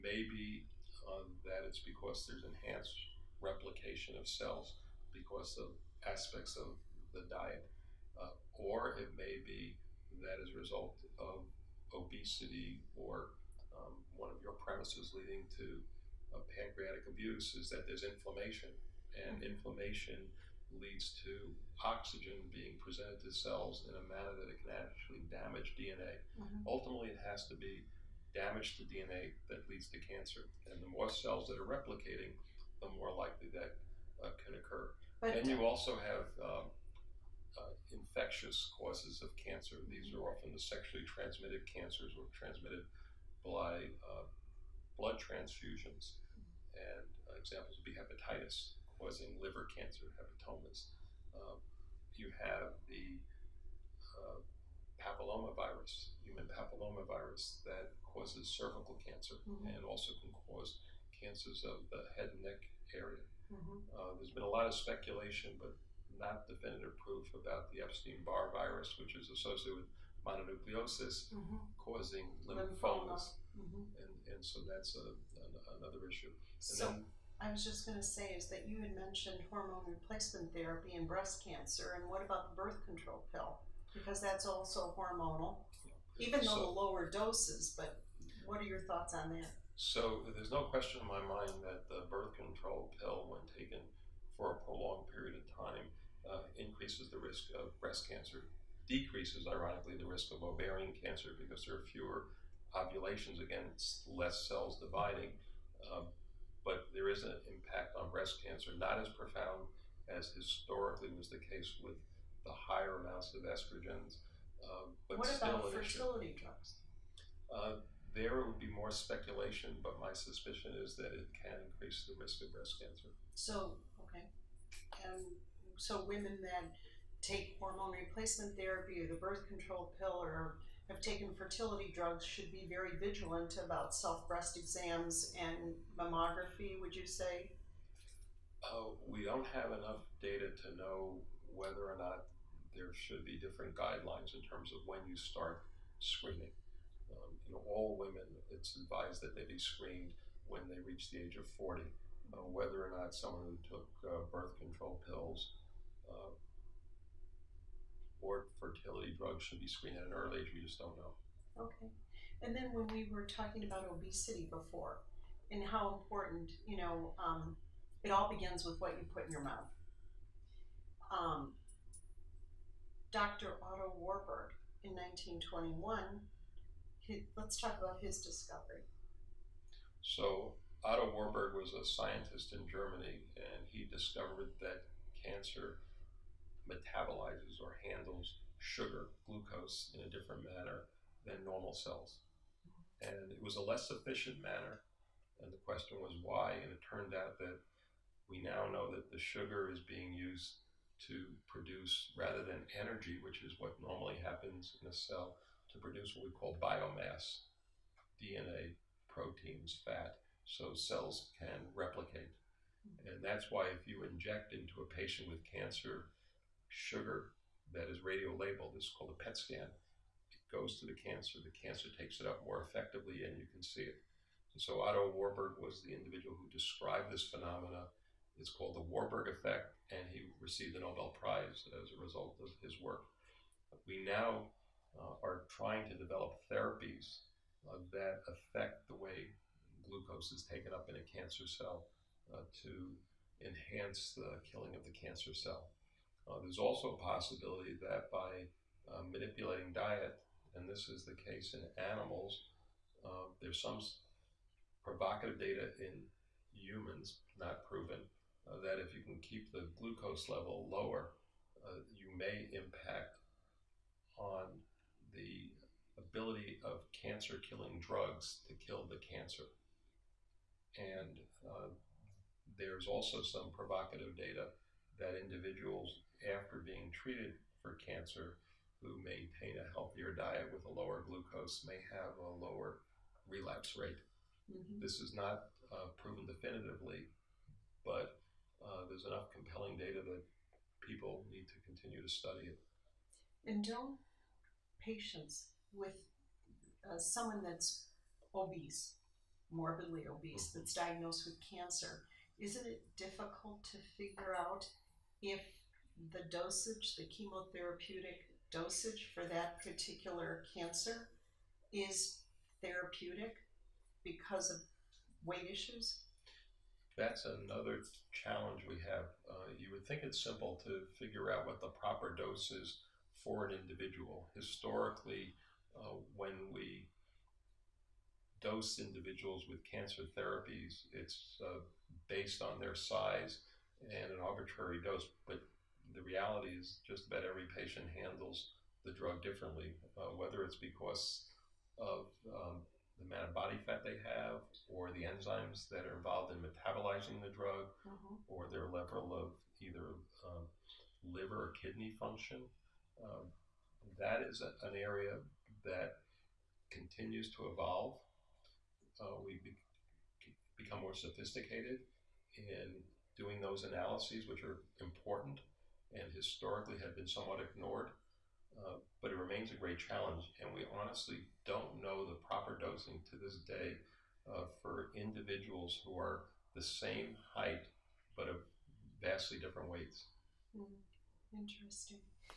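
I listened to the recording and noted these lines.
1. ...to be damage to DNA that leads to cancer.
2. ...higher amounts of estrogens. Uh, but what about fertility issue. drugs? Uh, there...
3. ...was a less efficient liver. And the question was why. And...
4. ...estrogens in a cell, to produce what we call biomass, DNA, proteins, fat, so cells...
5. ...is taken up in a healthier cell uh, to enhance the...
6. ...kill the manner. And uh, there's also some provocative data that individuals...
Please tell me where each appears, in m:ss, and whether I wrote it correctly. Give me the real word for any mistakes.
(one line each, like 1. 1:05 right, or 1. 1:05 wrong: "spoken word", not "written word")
1. 0:27 right
2. 1:52 right
3. 3:13 wrong: "manner", not "liver"
4. 3:24 wrong: "happens", not "estrogens"
5. 4:00 wrong: "cancer", not "healthier"
6. 4:28 wrong: "cancer", not "manner".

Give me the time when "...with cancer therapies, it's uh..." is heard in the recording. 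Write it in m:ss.
5:29.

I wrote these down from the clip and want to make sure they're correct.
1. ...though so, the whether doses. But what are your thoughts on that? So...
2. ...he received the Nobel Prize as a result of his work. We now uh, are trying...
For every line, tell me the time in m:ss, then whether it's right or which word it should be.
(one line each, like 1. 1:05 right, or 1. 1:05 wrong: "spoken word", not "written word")
1. 1:26 wrong: "lower", not "whether"
2. 3:50 right.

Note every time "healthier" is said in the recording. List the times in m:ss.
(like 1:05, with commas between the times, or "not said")
4:39.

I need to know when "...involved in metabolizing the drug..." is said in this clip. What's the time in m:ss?
5:45.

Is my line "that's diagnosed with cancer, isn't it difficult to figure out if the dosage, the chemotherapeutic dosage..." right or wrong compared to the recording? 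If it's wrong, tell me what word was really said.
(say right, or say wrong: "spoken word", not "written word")
right.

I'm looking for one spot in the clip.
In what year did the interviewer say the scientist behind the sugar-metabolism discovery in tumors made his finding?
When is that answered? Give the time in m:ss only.
2:54.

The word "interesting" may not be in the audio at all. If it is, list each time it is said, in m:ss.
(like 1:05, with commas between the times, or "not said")
6:21.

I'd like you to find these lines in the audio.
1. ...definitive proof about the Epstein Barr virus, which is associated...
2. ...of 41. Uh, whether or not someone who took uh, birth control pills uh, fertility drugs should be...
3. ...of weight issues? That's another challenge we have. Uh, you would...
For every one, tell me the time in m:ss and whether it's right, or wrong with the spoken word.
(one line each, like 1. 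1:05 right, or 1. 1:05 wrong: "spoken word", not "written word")
1. 1:06 right
2. 2:31 wrong: "40", not "41"
3. 5:14 right.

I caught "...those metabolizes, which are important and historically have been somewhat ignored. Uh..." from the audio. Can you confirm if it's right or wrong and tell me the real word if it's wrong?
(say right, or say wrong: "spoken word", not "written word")
wrong: "analyses", not "metabolizes".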